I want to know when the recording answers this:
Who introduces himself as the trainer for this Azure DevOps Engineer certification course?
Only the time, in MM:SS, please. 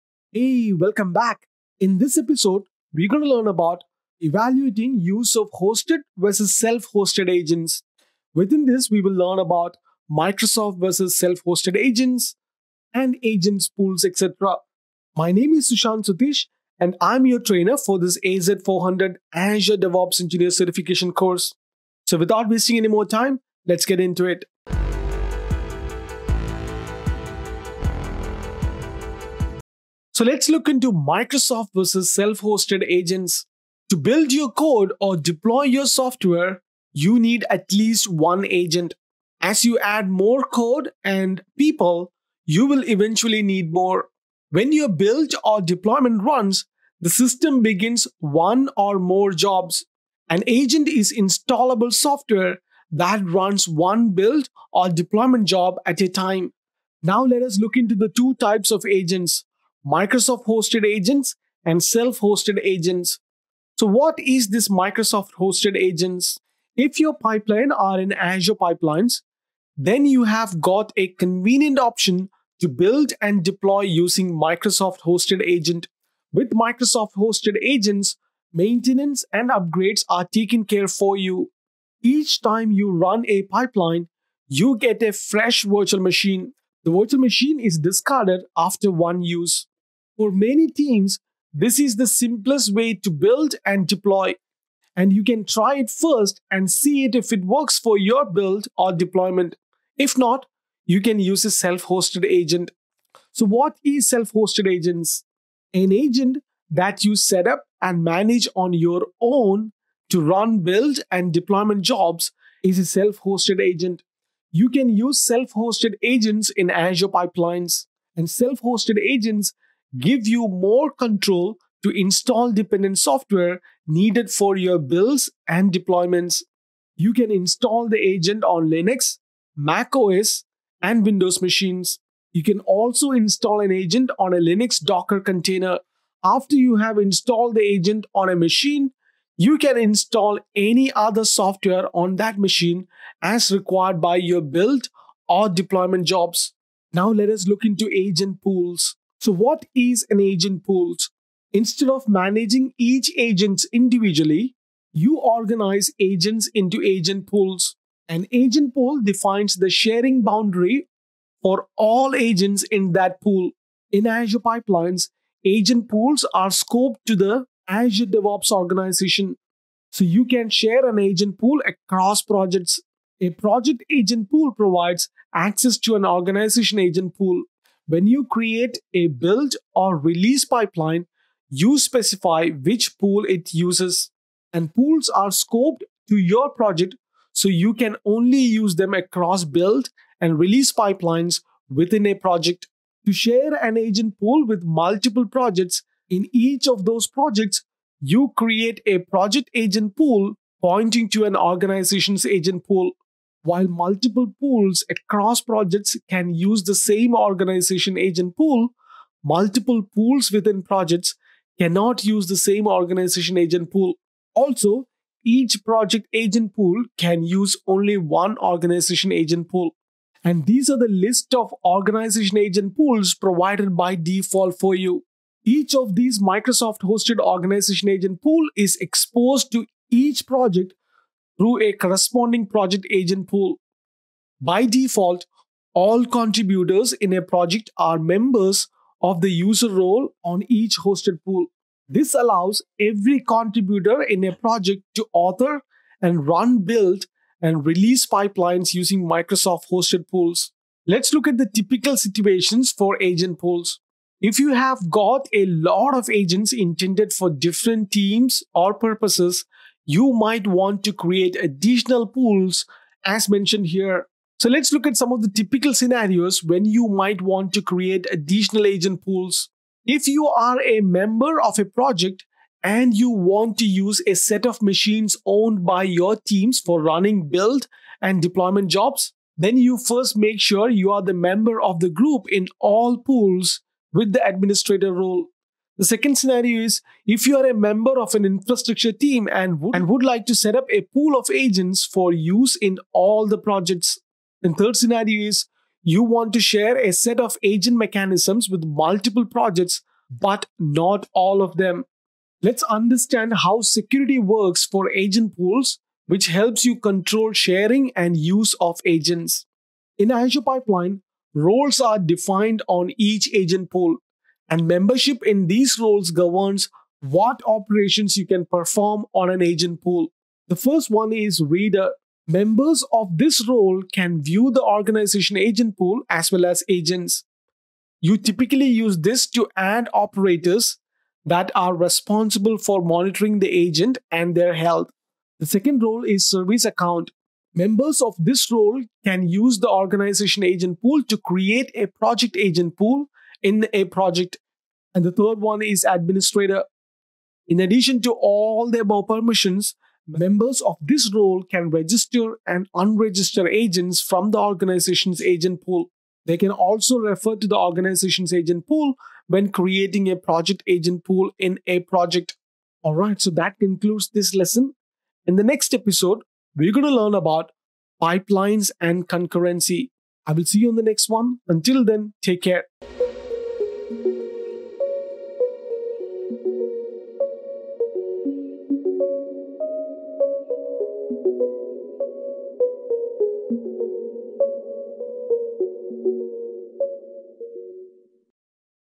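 00:15.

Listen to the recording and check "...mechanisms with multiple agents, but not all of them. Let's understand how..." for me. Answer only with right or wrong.
wrong.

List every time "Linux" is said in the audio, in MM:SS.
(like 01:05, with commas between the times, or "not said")
02:08, 02:14.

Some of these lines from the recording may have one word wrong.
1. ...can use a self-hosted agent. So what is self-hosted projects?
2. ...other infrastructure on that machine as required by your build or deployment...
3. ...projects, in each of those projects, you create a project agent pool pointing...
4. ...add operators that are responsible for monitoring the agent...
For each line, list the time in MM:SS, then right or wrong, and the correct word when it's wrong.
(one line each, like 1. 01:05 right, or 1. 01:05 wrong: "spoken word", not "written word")
1. 01:41 wrong: "agents", not "projects"
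2. 02:20 wrong: "software", not "infrastructure"
3. 03:15 right
4. 05:29 right.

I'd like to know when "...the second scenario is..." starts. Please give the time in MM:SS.
04:45.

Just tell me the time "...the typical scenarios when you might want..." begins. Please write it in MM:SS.
04:25.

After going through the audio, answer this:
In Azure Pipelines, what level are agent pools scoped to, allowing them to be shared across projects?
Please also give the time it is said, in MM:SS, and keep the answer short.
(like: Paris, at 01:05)
Azure DevOps organization, at 02:47.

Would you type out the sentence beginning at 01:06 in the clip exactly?
If your pipeline are in Azure pipelines, then you have got a convenient option to build and deploy using Microsoft hosted agent.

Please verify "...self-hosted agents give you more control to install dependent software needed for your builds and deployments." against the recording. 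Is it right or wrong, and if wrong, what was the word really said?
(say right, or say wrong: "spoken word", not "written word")
right.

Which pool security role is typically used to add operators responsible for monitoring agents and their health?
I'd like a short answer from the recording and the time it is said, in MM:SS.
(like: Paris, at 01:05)
Reader, at 05:21.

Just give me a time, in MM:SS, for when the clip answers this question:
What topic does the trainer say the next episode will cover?
06:08.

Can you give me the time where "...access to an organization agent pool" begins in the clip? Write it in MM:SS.
02:55.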